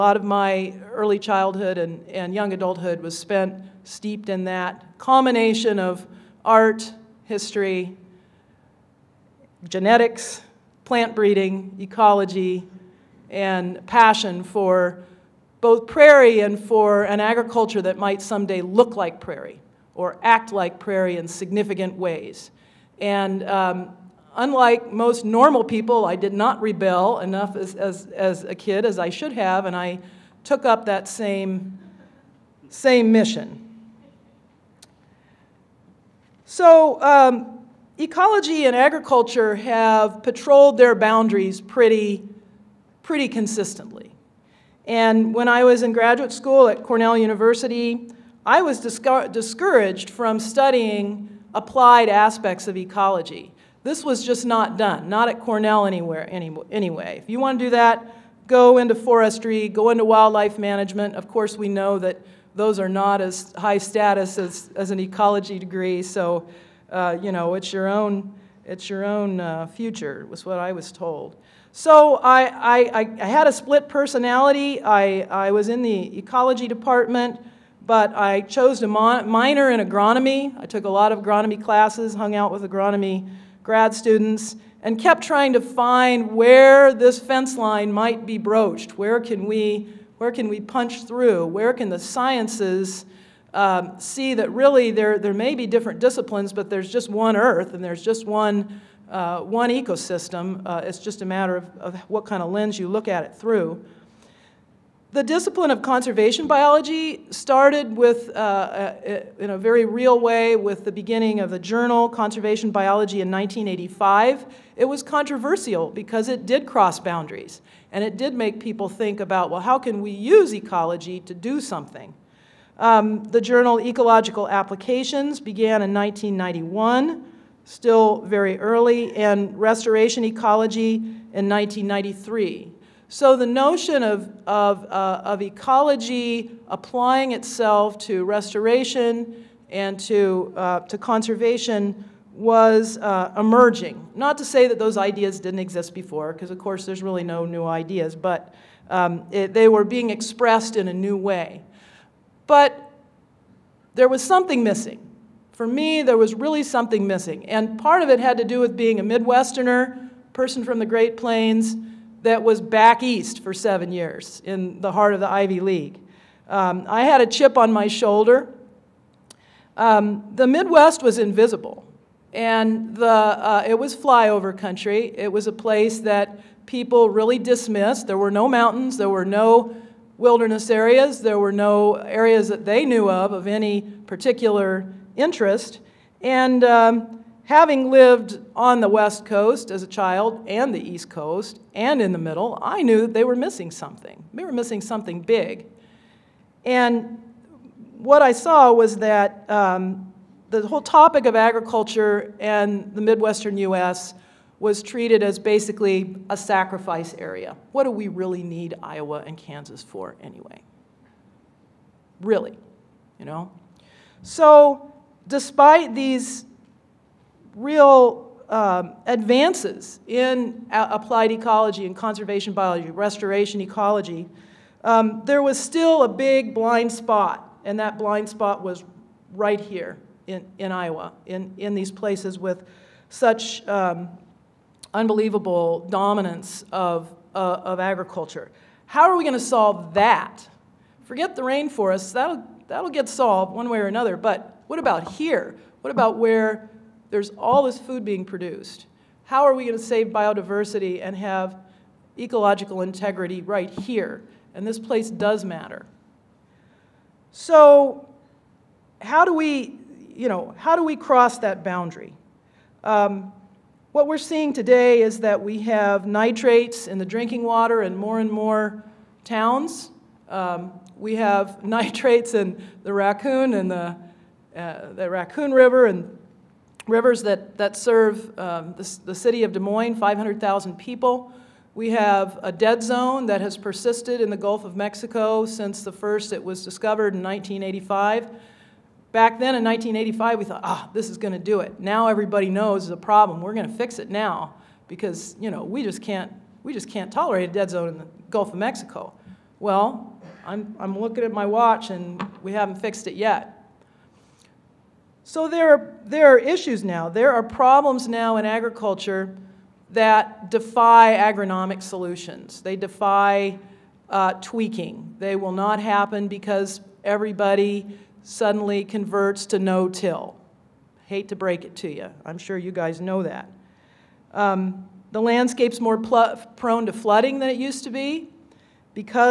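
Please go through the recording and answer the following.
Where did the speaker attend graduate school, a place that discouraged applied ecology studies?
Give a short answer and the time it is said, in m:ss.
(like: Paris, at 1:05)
Cornell University, at 0:46.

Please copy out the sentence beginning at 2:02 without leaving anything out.
Um, the journal Ecological Applications began in 1991 still very early, and restoration ecology in 1993.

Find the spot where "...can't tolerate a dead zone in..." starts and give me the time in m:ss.
4:56.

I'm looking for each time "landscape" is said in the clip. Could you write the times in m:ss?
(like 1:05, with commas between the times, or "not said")
5:25.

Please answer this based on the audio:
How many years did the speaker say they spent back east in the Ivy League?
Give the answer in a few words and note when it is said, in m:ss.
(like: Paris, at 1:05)
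7, at 2:43.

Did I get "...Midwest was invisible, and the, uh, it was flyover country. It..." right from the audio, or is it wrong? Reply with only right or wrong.
right.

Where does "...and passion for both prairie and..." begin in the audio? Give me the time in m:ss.
0:13.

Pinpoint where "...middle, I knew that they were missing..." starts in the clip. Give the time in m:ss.
3:12.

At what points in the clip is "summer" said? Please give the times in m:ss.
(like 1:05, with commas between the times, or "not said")
not said.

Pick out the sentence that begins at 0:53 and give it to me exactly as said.
This was just not done, not at Cornell anywhere any, anyway.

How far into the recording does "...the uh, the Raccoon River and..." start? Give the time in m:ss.
4:33.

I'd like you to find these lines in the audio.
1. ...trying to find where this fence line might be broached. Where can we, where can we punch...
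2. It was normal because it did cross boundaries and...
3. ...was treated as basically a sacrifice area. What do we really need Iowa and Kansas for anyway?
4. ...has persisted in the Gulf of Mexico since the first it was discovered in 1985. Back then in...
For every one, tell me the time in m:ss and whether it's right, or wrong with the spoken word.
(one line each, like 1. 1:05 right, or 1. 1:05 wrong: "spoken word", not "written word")
1. 1:25 right
2. 1:54 wrong: "controversial", not "normal"
3. 3:24 right
4. 4:43 right.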